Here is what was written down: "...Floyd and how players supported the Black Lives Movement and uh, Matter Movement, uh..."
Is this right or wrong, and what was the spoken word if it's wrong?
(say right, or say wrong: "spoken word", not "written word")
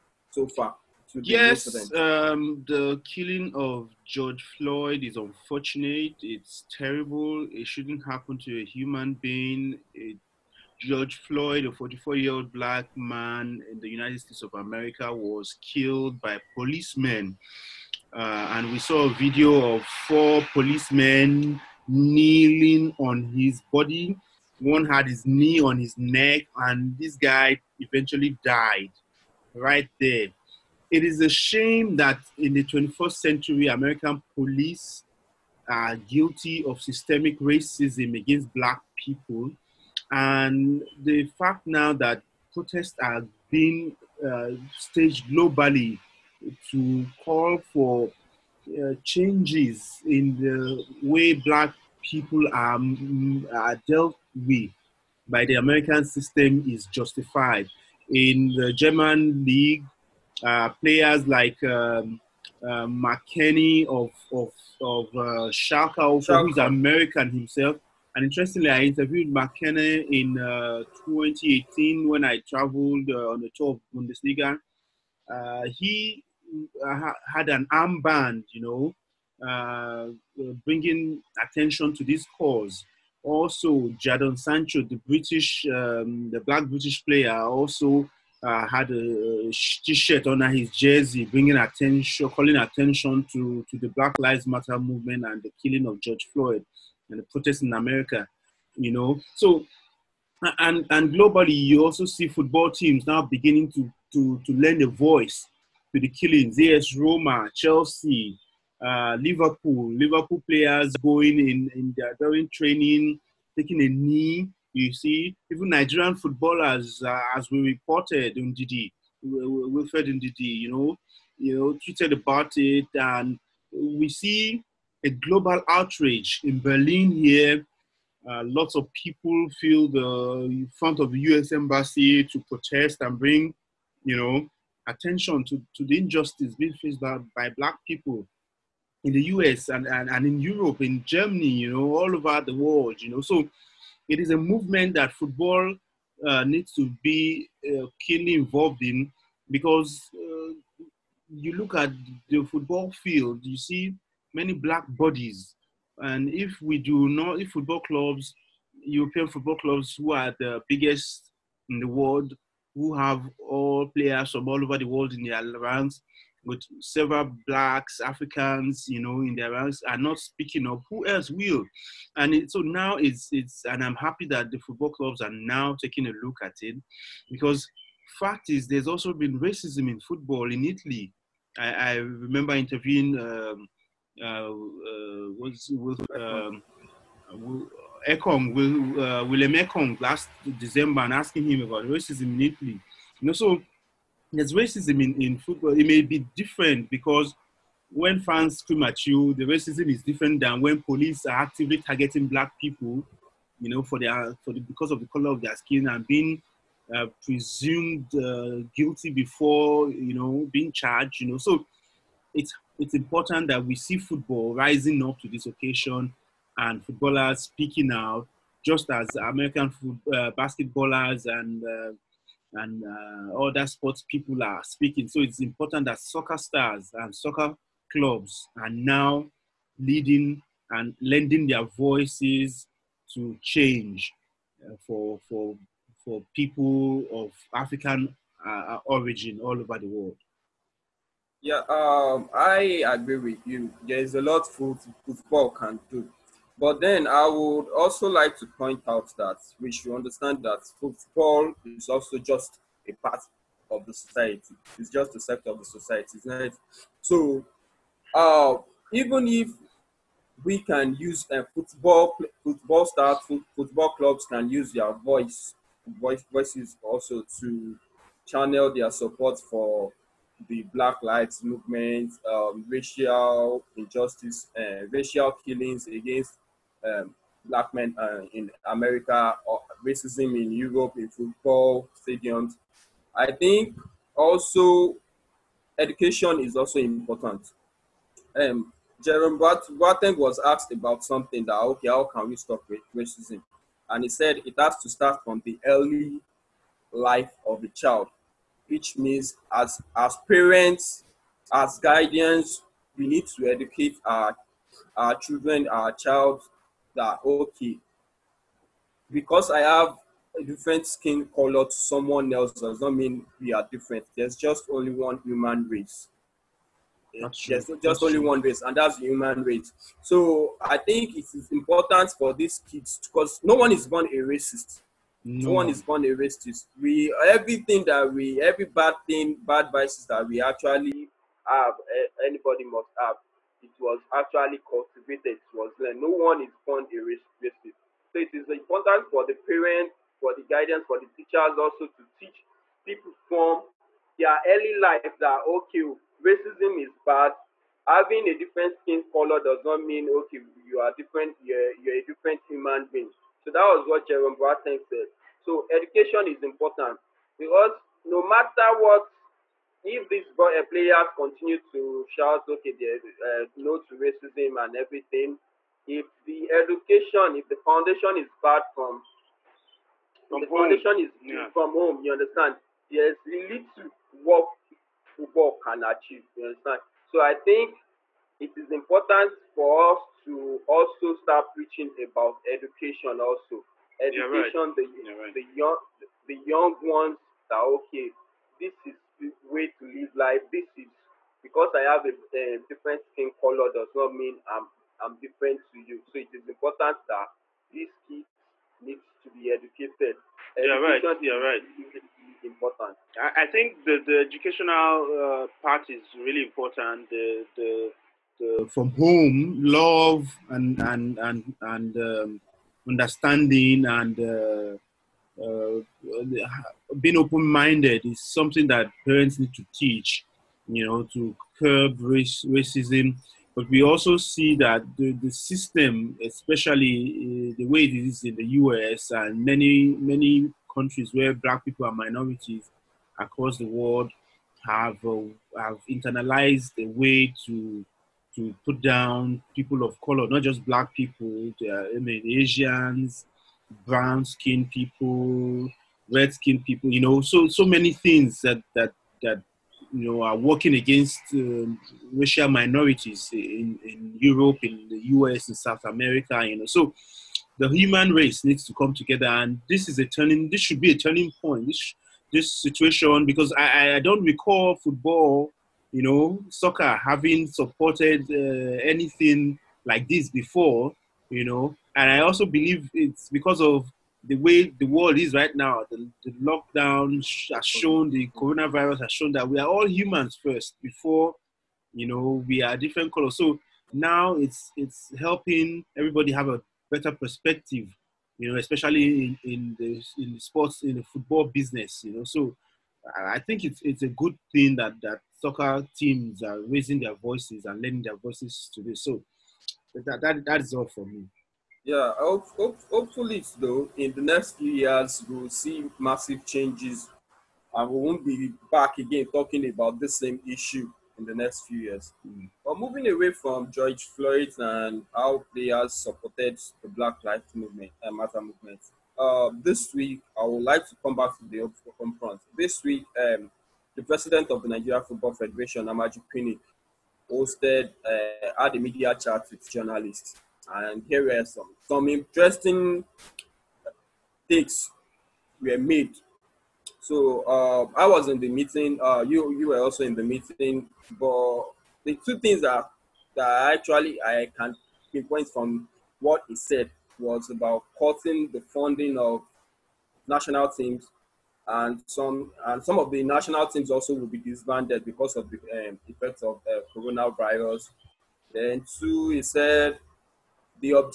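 right.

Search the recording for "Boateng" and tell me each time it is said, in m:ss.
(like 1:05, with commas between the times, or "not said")
4:49, 5:54.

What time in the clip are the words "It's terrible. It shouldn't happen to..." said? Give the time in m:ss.
0:06.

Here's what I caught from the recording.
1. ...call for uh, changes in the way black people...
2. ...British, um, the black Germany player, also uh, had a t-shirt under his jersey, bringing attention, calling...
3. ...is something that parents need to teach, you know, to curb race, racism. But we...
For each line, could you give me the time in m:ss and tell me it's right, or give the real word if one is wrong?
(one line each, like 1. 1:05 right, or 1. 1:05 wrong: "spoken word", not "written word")
1. 0:47 right
2. 1:25 wrong: "British", not "Germany"
3. 6:58 right.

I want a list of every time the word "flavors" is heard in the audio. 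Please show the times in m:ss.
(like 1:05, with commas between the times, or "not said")
not said.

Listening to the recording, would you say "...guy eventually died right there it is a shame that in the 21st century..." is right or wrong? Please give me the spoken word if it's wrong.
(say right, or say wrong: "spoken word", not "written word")
right.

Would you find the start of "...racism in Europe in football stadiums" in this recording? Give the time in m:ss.
4:39.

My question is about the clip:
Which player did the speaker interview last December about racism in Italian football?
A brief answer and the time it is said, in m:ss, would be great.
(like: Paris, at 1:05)
William Ekong, at 3:09.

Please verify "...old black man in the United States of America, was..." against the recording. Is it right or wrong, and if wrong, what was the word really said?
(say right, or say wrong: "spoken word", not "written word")
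right.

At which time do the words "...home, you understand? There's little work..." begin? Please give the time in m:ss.
6:11.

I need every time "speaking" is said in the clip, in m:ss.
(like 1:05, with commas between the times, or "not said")
2:50, 3:37, 3:44.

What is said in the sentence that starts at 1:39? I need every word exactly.
So, and and globally, you also see football teams now beginning to to to lend a voice to the killings.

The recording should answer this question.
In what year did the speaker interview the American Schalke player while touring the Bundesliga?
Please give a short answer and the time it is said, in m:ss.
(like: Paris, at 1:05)
2018, at 1:11.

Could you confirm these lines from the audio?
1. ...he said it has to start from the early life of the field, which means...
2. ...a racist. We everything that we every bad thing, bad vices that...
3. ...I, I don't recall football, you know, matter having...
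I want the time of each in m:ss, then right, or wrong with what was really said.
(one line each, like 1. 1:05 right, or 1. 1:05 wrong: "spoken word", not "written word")
1. 4:54 wrong: "child", not "field"
2. 5:26 right
3. 7:43 wrong: "soccer", not "matter".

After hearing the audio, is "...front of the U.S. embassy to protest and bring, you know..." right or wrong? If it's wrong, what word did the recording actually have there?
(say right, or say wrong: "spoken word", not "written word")
right.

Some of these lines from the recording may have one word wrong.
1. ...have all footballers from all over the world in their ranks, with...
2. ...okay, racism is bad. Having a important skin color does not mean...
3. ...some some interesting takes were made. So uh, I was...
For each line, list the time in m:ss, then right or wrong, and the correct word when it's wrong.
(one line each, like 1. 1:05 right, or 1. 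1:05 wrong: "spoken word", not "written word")
1. 2:42 wrong: "players", not "footballers"
2. 5:45 wrong: "different", not "important"
3. 8:51 right.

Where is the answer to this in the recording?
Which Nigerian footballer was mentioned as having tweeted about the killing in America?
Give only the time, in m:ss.
1:59.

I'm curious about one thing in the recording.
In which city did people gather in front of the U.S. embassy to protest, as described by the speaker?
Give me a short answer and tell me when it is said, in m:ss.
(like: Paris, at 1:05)
Berlin, at 2:06.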